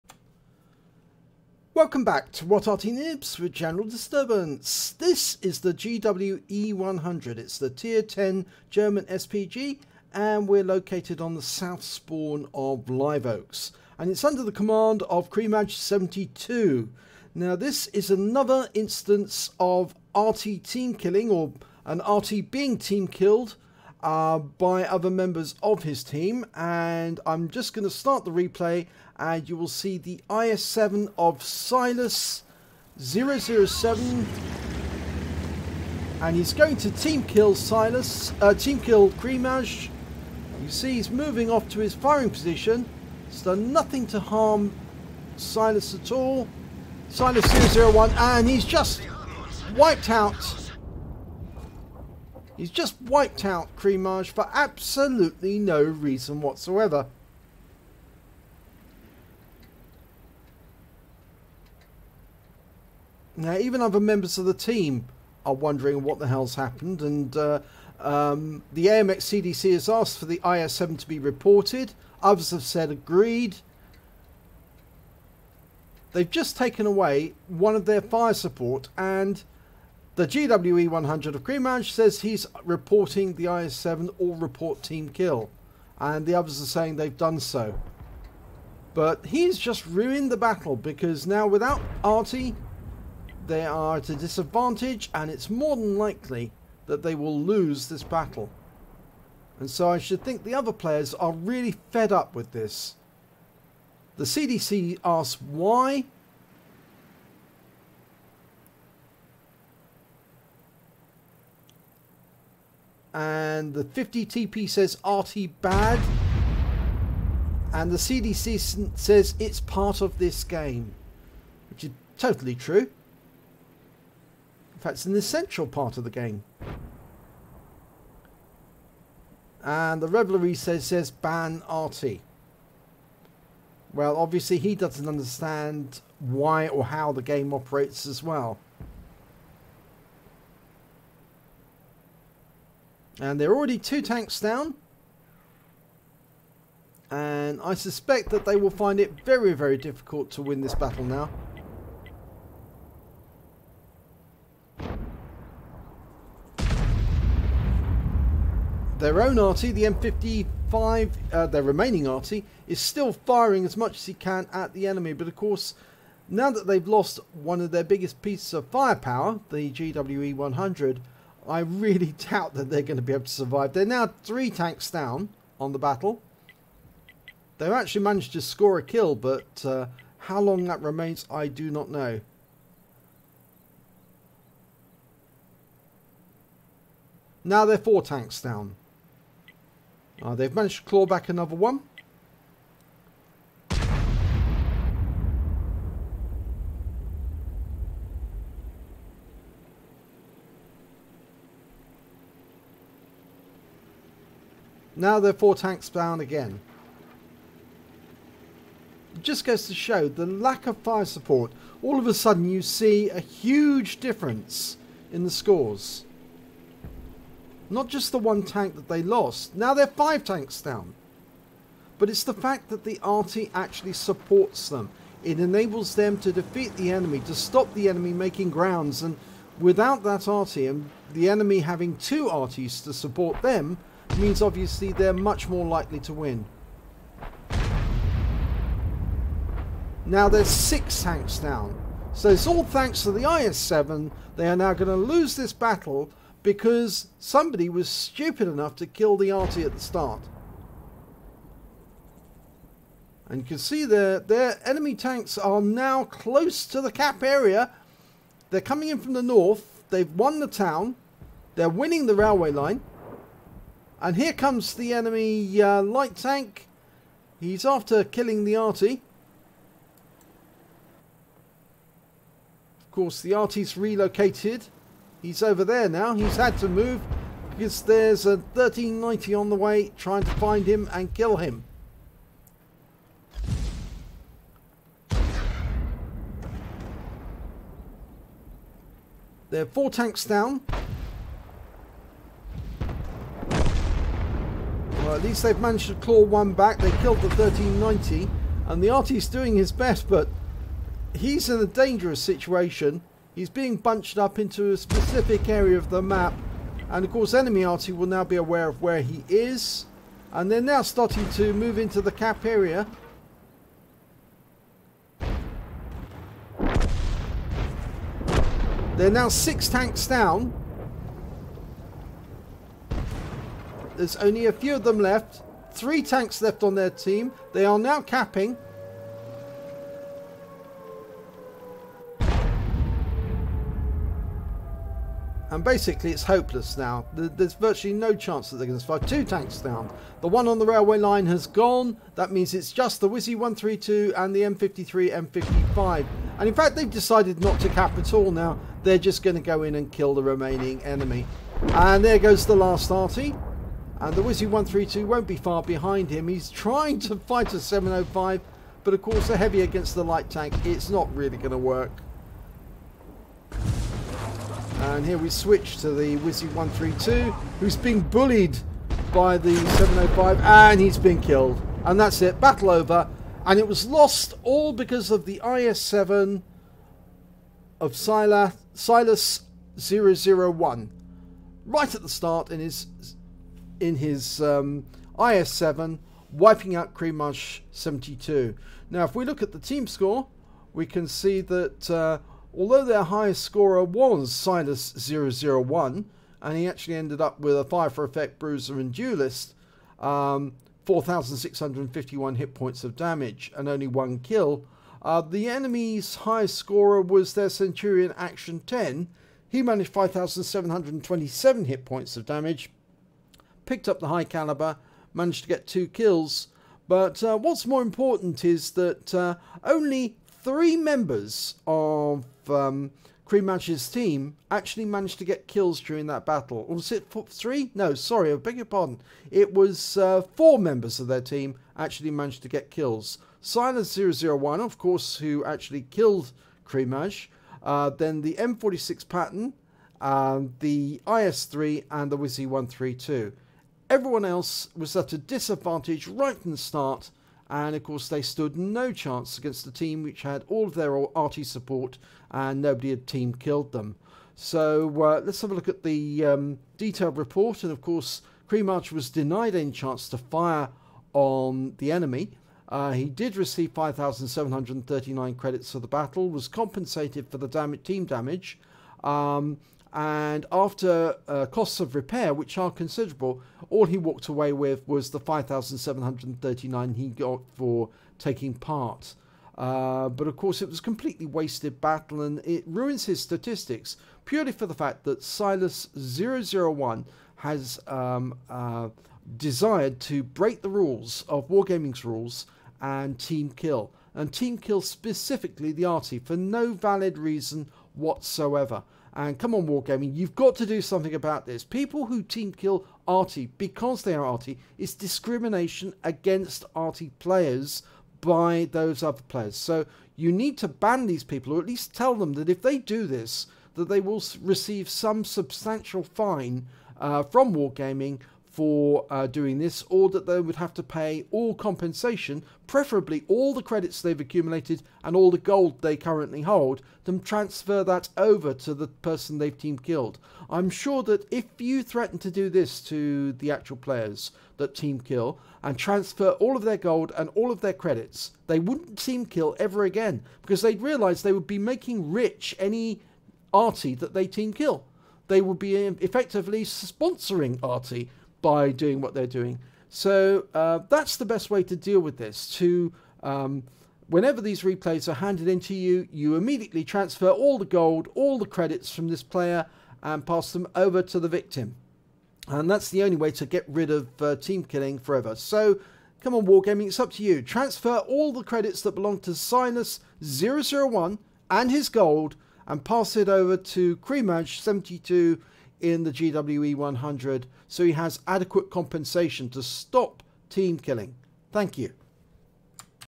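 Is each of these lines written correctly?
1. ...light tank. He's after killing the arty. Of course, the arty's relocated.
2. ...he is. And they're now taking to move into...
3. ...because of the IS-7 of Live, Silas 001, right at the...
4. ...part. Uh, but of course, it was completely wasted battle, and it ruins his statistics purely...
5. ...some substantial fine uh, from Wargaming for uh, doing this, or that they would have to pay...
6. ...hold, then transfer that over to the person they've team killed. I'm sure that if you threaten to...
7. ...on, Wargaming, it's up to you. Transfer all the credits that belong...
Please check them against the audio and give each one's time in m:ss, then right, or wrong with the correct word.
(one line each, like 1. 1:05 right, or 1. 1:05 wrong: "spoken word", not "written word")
1. 4:25 right
2. 5:09 wrong: "starting", not "taking"
3. 6:14 wrong: "Silas", not "Live"
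4. 7:58 right
5. 8:34 right
6. 8:46 right
7. 9:26 right.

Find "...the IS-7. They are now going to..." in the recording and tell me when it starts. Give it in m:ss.
4:03.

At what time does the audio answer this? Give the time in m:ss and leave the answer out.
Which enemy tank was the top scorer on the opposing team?
6:47.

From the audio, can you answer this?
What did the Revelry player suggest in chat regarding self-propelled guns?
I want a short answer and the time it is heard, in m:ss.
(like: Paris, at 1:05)
ban arty, at 2:11.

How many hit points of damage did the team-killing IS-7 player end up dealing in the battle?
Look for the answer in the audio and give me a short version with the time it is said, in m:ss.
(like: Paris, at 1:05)
4,651, at 6:40.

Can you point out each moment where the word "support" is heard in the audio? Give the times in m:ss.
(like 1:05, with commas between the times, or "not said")
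1:18, 3:31, 3:43, 3:52, 7:31.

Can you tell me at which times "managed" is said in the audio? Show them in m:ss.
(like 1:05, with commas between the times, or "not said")
2:58, 3:10, 4:55, 6:49, 6:55, 7:04, 7:12.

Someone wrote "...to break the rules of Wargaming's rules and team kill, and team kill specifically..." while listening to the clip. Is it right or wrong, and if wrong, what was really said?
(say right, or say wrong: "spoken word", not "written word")
right.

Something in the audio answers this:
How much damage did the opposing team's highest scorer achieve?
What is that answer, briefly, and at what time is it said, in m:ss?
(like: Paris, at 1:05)
5,727, at 6:49.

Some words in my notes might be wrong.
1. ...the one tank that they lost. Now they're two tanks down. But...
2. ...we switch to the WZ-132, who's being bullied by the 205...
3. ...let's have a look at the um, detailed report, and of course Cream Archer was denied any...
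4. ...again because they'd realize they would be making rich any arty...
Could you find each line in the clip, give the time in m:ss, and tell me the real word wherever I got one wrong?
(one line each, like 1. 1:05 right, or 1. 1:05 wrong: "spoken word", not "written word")
1. 3:38 wrong: "five", not "two"
2. 6:05 wrong: "705", not "205"
3. 7:35 right
4. 8:59 right.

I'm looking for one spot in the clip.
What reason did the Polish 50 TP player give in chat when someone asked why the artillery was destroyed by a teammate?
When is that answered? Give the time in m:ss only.
1:55.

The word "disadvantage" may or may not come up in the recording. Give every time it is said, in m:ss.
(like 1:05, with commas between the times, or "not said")
1:34, 7:25.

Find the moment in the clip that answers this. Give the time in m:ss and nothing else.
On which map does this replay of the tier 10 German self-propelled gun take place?
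0:12.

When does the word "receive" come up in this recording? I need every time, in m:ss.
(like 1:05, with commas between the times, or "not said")
7:43, 8:34.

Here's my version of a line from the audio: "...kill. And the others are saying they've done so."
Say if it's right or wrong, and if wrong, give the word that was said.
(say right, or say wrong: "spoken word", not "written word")
right.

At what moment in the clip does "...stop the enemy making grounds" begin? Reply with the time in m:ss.
3:47.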